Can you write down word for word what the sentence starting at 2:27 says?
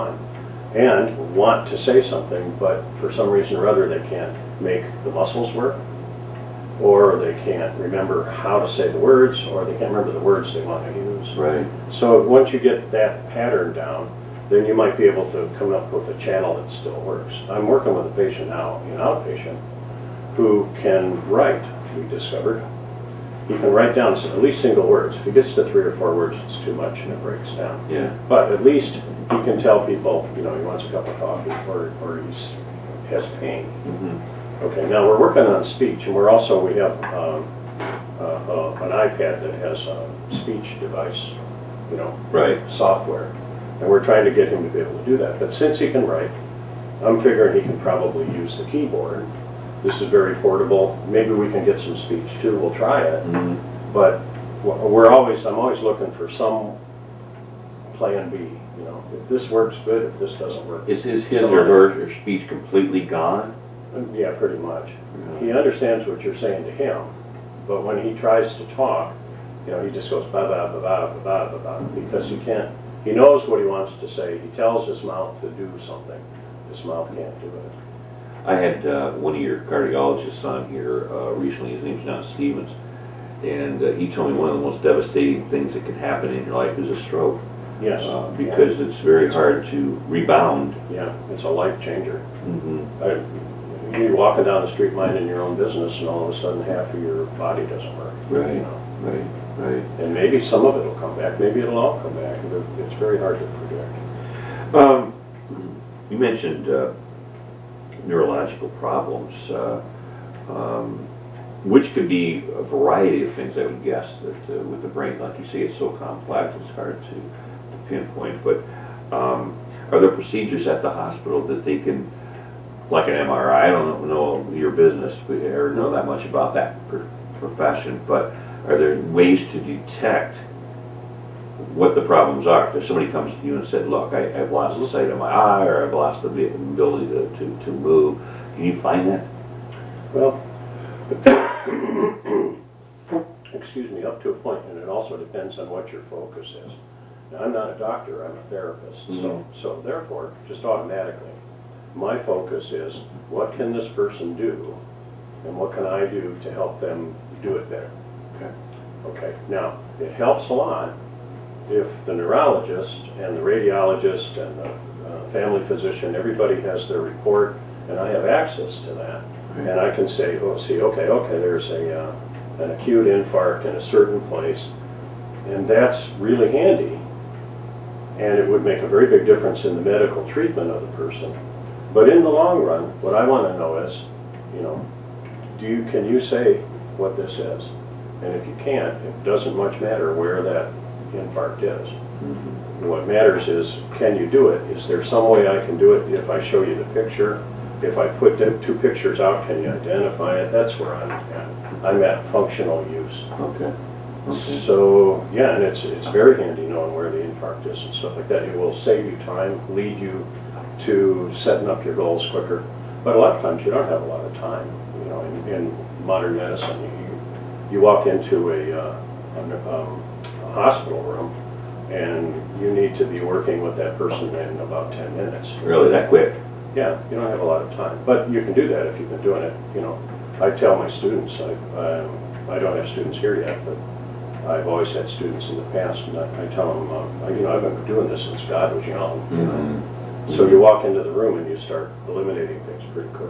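Now, I'm not a doctor, I'm a therapist, mm -hmm.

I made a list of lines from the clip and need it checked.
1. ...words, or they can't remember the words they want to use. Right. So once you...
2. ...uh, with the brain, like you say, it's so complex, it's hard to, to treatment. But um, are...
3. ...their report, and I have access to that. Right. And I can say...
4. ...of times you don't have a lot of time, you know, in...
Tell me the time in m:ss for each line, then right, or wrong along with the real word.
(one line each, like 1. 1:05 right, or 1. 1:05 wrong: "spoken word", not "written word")
1. 0:09 right
2. 1:54 wrong: "pinpoint", not "treatment"
3. 2:46 right
4. 3:33 right.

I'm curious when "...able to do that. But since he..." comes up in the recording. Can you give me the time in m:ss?
0:44.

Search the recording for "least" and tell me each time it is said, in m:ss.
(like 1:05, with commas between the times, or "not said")
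0:24, 0:28.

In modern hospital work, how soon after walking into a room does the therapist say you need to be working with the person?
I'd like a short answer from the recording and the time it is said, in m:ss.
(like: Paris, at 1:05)
10 minutes, at 3:44.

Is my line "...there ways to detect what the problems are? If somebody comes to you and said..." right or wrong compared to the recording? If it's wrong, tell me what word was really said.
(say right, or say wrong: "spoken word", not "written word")
right.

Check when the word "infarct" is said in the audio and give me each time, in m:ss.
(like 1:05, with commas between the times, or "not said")
2:53, 3:11, 3:27.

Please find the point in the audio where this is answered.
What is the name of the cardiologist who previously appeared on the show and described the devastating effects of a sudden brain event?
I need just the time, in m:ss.
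1:22.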